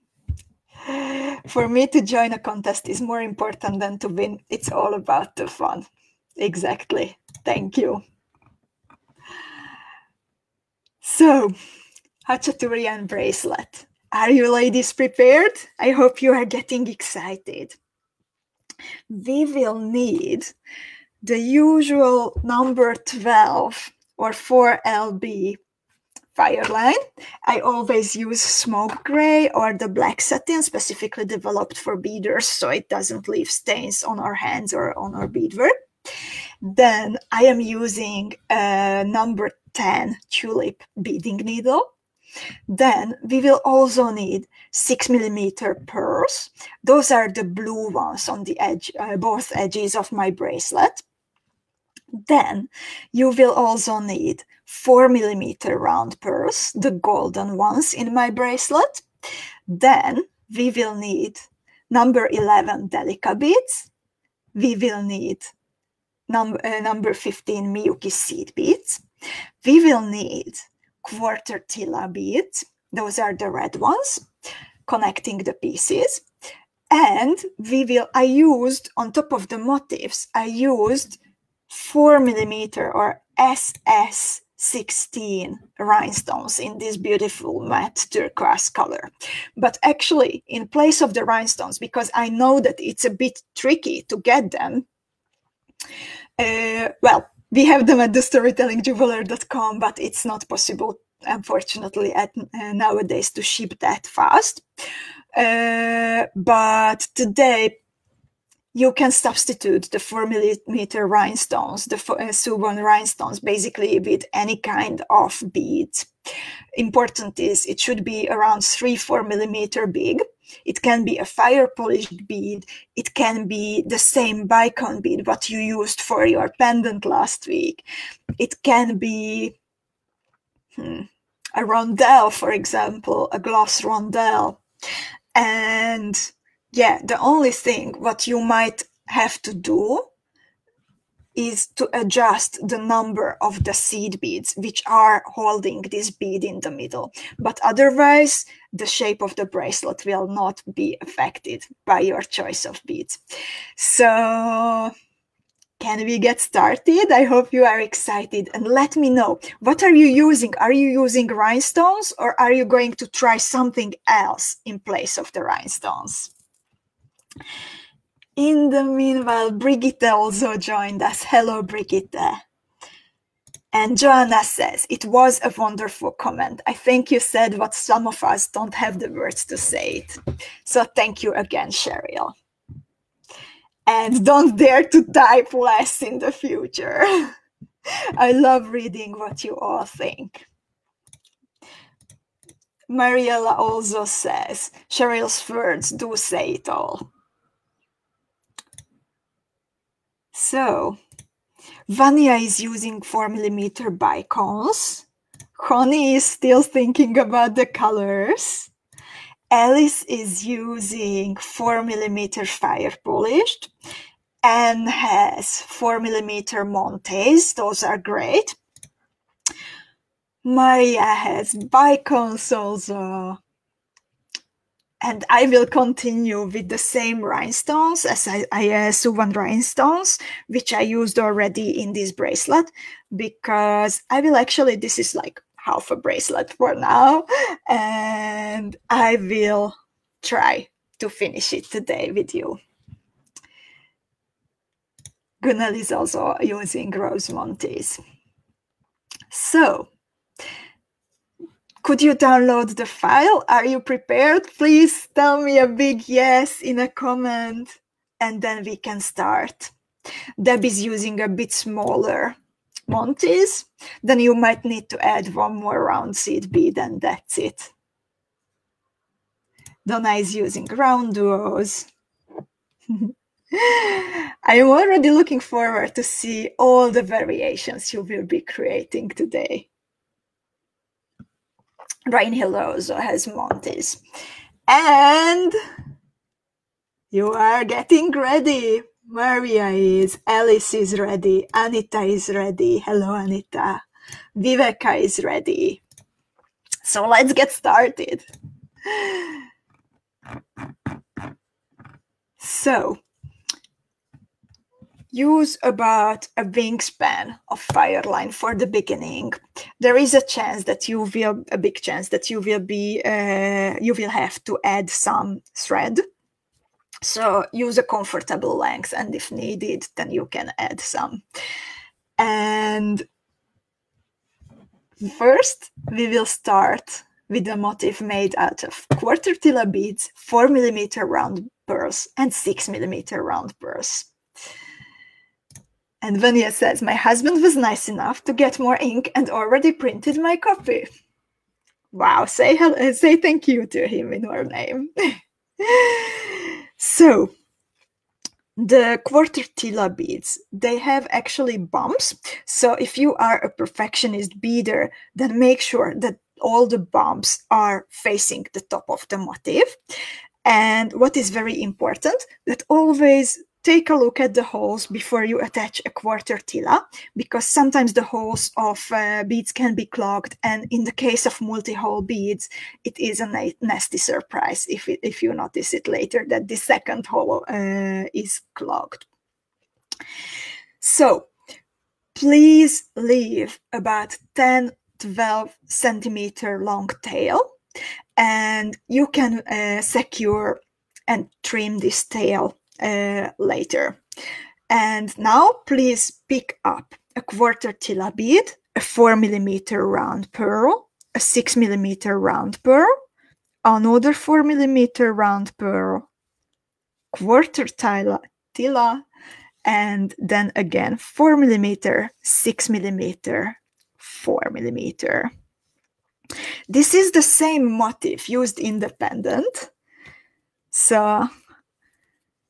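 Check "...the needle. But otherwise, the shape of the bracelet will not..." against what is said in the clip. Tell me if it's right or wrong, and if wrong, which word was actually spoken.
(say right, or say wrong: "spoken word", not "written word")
wrong: "middle", not "needle".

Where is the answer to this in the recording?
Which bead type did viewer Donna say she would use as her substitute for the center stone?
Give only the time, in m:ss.
4:30.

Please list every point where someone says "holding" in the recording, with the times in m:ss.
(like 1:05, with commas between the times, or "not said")
2:25.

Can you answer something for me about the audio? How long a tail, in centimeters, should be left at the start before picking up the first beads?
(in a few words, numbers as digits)
10 to 12 centimeters.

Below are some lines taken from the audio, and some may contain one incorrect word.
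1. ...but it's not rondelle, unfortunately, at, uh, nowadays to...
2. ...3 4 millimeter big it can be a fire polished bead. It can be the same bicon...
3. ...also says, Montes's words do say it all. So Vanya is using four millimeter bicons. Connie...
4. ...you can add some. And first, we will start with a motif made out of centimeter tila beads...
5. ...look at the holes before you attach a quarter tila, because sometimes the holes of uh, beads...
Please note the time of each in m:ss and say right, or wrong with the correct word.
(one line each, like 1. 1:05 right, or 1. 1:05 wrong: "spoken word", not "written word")
1. 1:39 wrong: "possible", not "rondelle"
2. 1:58 right
3. 3:13 wrong: "Cheryl", not "Montes"
4. 5:20 wrong: "quarter", not "centimeter"
5. 6:03 right.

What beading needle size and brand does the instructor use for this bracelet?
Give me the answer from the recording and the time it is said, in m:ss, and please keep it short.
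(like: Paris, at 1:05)
Number 10 Tulip, at 0:39.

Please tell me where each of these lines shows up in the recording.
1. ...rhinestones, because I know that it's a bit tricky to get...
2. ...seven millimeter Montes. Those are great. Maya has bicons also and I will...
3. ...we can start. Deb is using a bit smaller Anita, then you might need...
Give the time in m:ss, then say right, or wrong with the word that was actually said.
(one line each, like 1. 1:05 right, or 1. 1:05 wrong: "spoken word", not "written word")
1. 1:31 right
2. 3:35 wrong: "four", not "seven"
3. 4:18 wrong: "Montes", not "Anita".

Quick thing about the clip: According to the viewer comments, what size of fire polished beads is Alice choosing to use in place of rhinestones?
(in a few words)
4 millimeter.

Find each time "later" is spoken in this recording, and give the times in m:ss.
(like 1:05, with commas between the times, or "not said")
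6:15, 6:33.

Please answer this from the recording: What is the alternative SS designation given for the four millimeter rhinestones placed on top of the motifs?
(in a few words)
SS 16.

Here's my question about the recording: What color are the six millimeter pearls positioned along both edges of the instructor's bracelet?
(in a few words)
Blue.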